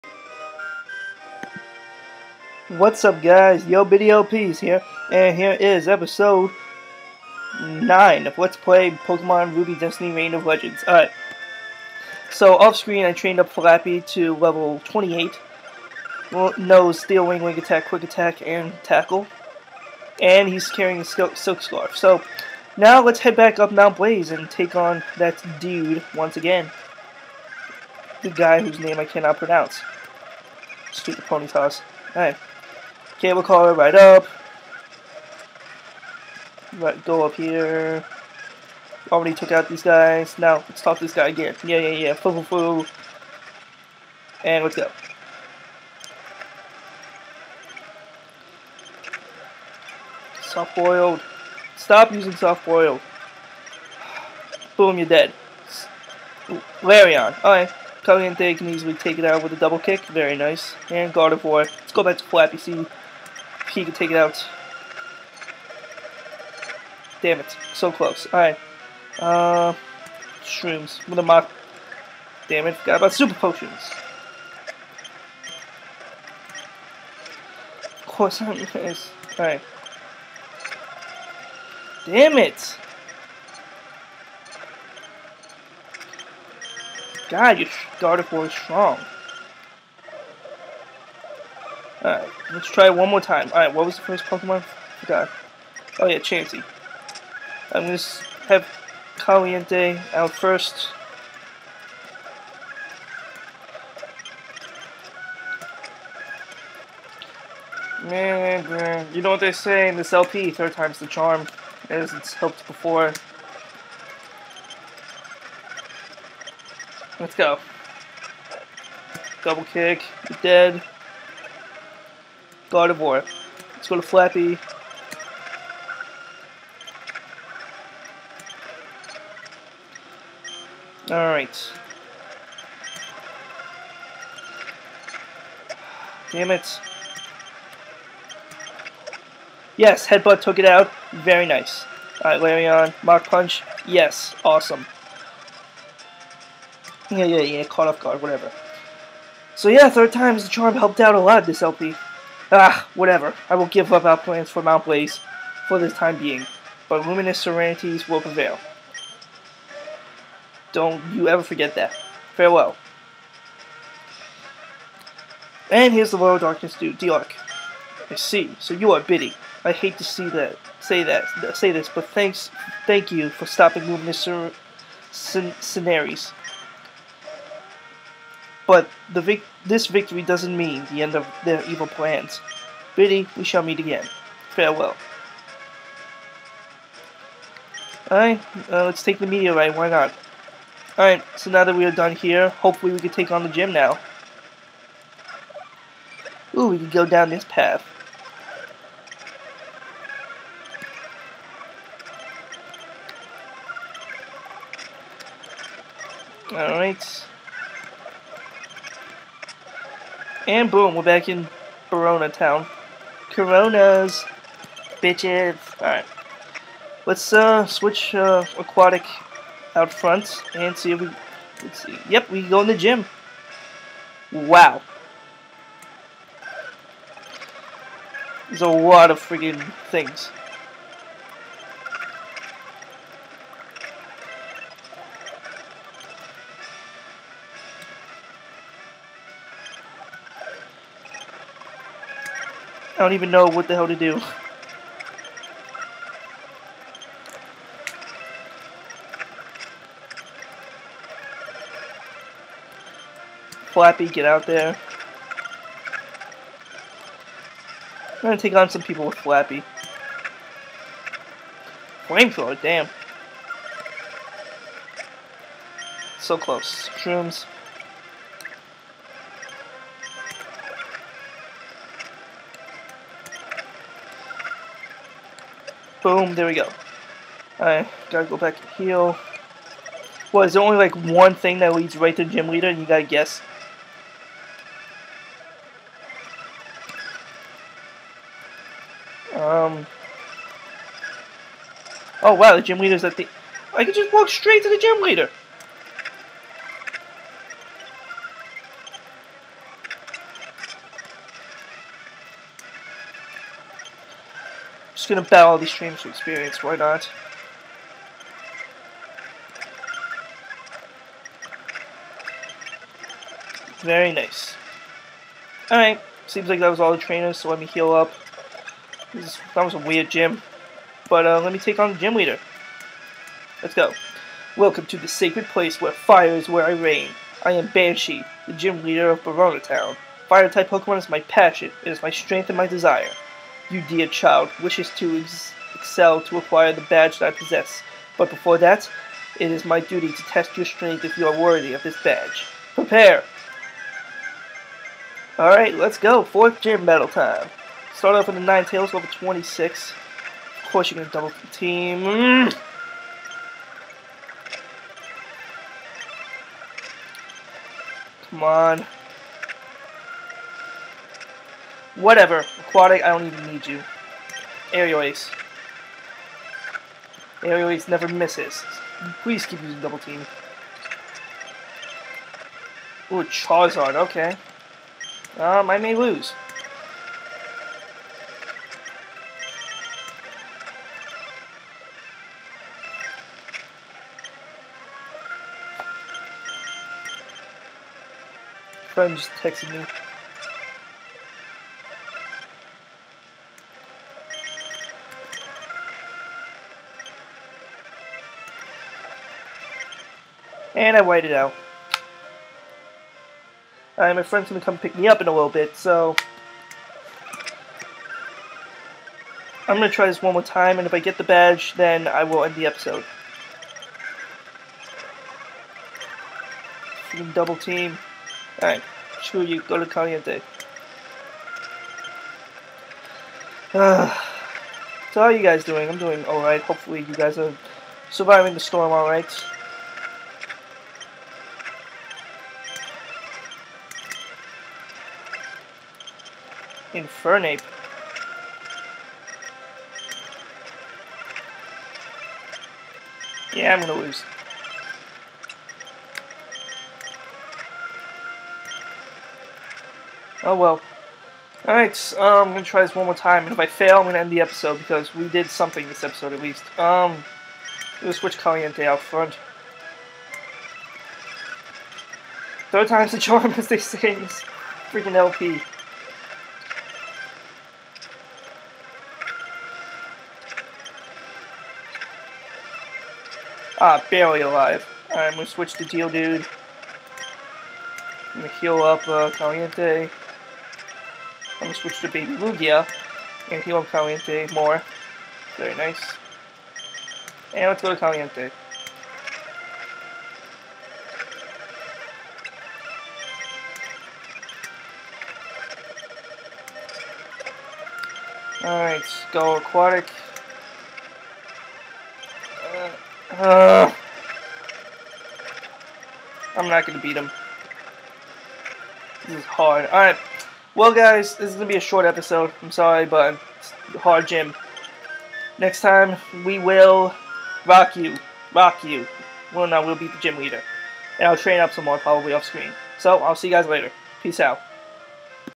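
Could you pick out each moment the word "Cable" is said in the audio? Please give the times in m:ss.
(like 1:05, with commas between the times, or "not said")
0:33.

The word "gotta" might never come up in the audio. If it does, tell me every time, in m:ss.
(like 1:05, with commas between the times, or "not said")
4:38, 4:42.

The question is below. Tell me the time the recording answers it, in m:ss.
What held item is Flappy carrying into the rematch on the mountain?
0:21.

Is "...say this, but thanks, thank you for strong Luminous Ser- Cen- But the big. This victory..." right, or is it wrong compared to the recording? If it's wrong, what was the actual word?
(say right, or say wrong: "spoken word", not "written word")
wrong: "stopping", not "strong".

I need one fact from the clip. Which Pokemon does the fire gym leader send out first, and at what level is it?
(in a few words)
Ninetales, level 26.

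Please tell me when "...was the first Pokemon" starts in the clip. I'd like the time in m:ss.
1:33.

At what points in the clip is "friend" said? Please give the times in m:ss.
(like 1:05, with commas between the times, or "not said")
6:28, 6:44.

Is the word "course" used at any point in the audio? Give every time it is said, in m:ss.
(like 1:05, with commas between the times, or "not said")
1:18, 5:50.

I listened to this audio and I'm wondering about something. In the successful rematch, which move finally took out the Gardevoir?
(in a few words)
Headbutt.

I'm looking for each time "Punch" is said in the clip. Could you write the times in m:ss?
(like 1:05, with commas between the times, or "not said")
2:23.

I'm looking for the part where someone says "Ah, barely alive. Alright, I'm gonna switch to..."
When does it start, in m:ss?
7:53.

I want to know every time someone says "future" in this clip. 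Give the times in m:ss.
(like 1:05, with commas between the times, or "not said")
not said.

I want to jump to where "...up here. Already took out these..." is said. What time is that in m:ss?
0:37.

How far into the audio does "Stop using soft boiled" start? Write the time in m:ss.
0:51.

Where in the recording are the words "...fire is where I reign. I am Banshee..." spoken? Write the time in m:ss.
5:25.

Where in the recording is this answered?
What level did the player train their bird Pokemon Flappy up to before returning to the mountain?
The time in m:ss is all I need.
0:14.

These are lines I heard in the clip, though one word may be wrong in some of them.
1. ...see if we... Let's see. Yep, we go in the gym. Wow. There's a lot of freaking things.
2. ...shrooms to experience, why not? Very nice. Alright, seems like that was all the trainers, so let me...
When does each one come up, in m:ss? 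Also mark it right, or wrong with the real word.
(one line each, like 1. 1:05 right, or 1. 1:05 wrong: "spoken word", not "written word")
1. 3:40 right
2. 5:05 wrong: "streams", not "shrooms".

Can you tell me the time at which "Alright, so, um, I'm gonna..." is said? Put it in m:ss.
7:31.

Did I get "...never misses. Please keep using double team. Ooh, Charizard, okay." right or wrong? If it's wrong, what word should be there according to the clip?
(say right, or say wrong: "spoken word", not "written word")
right.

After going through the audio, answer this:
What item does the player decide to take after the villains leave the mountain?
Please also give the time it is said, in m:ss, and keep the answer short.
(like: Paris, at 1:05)
Meteorite, at 3:09.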